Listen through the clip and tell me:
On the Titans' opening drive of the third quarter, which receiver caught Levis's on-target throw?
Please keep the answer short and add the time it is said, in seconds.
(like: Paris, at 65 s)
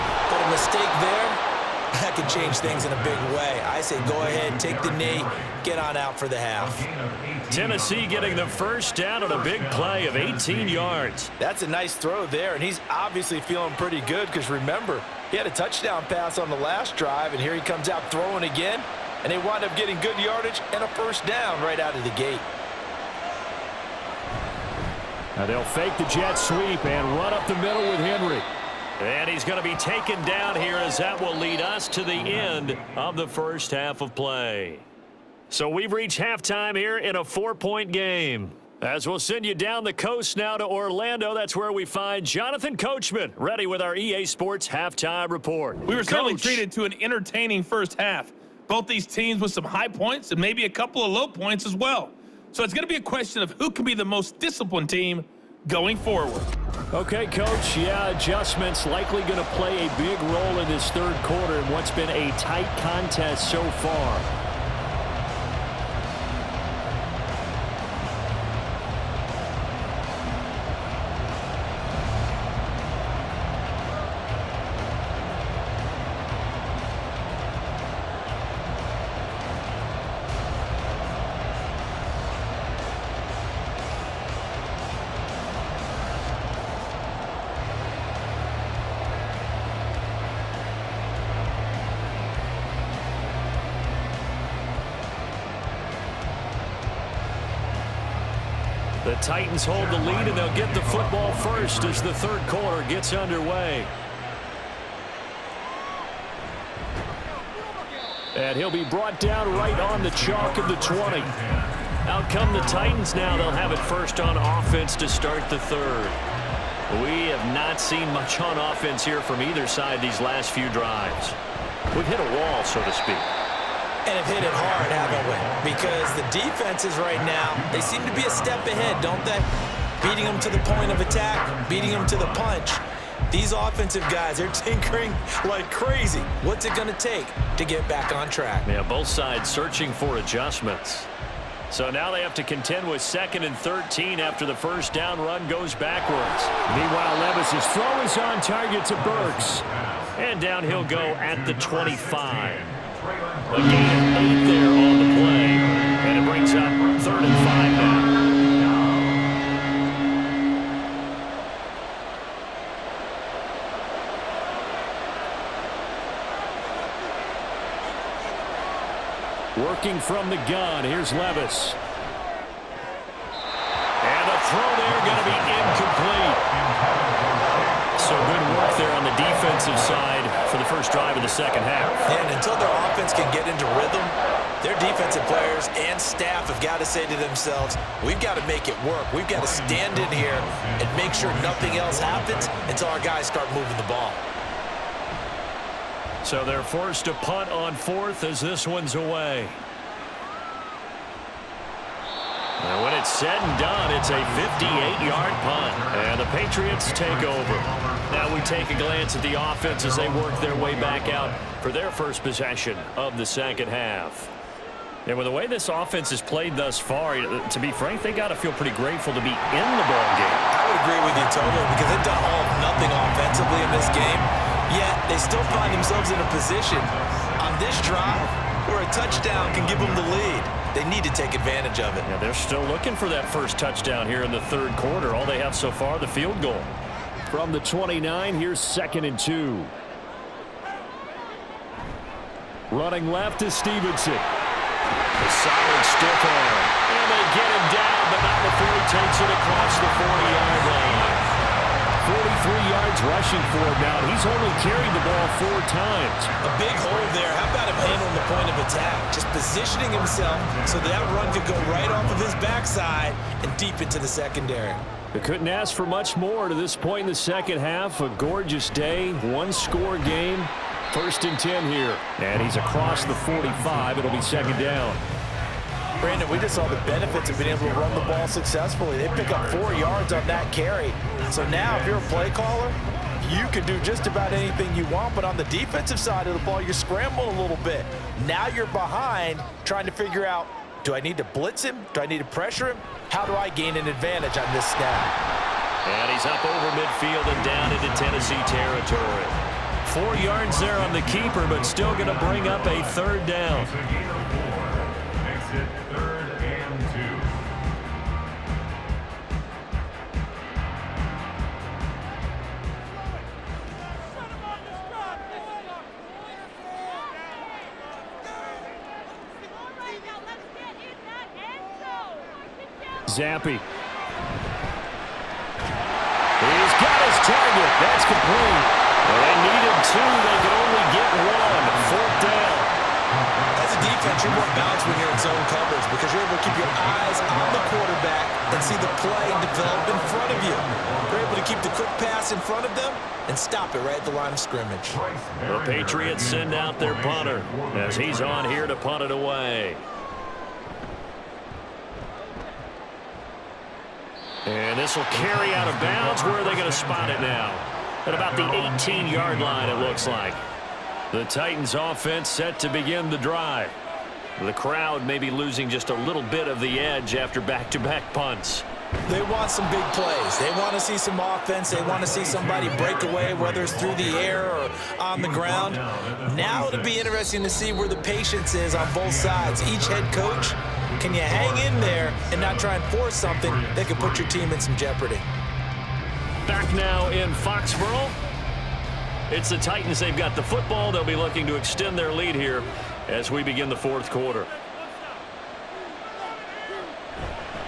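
Burks, at 149 s.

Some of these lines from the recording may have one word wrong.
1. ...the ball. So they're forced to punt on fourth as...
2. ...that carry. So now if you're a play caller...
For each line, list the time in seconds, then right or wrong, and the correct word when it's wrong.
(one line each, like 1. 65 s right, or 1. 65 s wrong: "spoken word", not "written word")
1. 193 s right
2. 280 s right.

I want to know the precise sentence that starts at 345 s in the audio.
The Patriots send out their punter as he's on here to punt it away.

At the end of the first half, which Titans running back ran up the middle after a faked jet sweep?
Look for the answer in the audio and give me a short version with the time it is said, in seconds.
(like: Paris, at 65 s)
Henry, at 28 s.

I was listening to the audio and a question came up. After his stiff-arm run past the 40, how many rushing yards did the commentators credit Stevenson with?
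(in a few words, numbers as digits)
43.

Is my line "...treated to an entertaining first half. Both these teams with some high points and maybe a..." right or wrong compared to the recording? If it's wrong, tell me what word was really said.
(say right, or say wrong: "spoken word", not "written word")
right.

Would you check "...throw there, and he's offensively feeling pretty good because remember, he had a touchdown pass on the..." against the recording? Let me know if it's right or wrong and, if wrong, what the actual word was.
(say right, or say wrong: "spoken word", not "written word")
wrong: "obviously", not "offensively".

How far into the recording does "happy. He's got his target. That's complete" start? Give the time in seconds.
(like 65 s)
323 s.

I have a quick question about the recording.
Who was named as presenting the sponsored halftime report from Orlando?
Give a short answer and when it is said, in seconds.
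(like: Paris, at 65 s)
Jonathan Coachman, at 42 s.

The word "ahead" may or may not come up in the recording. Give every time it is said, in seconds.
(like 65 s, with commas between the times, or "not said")
4 s, 128 s.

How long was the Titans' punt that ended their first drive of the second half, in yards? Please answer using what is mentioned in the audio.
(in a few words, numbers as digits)
58.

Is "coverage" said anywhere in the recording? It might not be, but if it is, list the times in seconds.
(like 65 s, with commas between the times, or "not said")
335 s.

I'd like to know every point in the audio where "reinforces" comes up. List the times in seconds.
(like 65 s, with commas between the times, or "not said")
not said.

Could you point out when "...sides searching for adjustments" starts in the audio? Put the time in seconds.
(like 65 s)
139 s.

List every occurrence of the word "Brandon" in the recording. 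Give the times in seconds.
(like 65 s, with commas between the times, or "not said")
276 s.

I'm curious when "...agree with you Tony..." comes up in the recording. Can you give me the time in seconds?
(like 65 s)
220 s.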